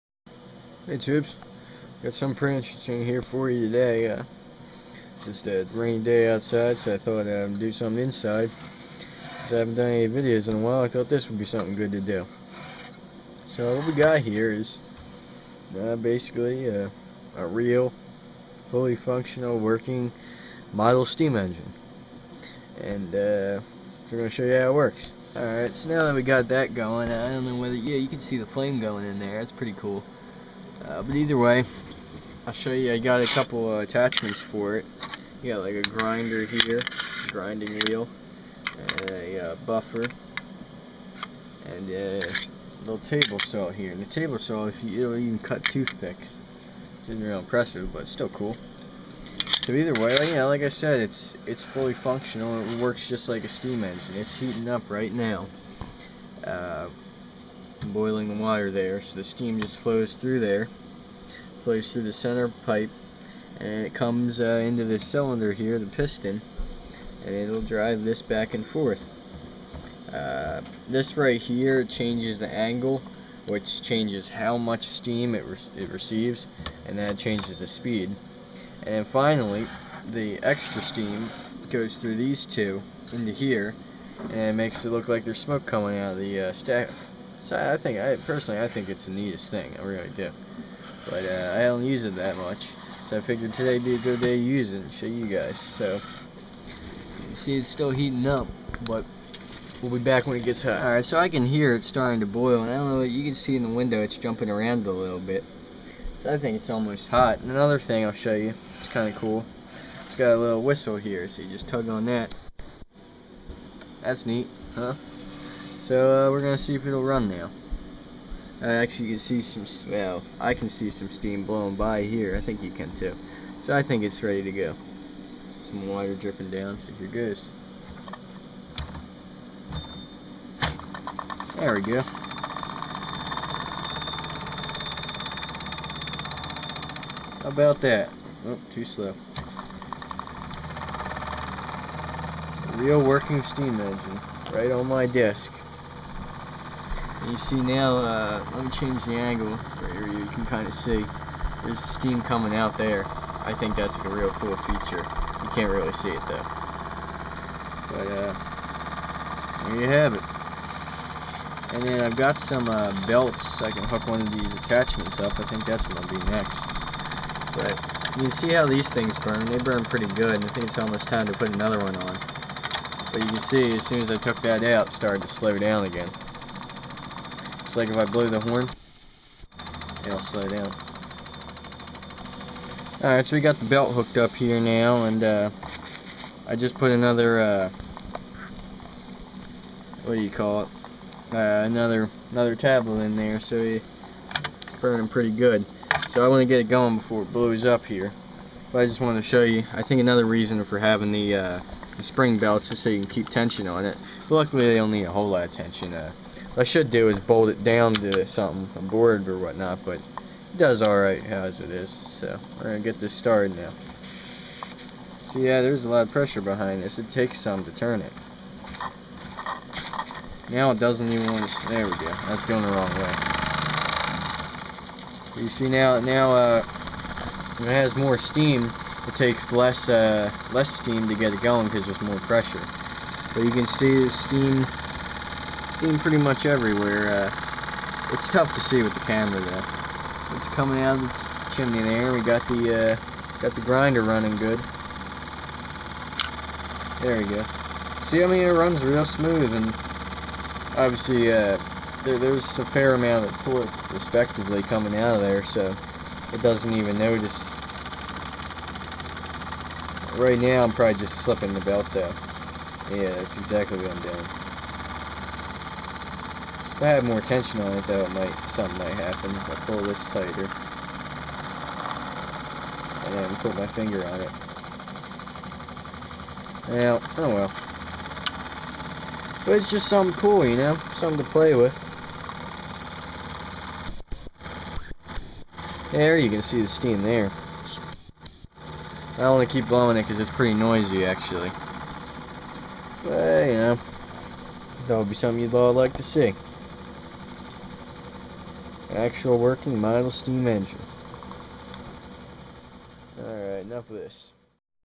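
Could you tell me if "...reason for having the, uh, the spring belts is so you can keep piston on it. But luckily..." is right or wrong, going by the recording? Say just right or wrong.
wrong.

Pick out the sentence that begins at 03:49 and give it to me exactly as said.
It takes less uh, less steam to get it going because there's more pressure.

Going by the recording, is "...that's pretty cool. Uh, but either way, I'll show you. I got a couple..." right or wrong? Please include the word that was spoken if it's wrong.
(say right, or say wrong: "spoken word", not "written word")
right.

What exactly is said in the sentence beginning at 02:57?
It's like if I blow the horn, it'll slow down.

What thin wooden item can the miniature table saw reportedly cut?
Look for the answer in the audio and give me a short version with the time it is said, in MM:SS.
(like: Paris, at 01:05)
Toothpicks, at 00:45.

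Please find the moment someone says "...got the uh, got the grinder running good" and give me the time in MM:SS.
04:02.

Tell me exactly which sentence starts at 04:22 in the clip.
Yeah, that's exactly what I'm doing.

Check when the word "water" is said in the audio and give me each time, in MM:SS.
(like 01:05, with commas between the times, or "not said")
00:58, 02:05.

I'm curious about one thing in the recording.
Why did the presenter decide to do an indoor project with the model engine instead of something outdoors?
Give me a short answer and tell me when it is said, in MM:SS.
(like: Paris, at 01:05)
A rainy day, at 00:05.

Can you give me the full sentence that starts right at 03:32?
So we're going to get this started now.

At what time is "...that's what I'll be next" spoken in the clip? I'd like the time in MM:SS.
02:45.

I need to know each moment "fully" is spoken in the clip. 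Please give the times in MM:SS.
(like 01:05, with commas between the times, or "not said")
00:18, 00:51.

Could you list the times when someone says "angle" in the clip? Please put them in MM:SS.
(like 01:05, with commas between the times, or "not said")
01:12, 02:29.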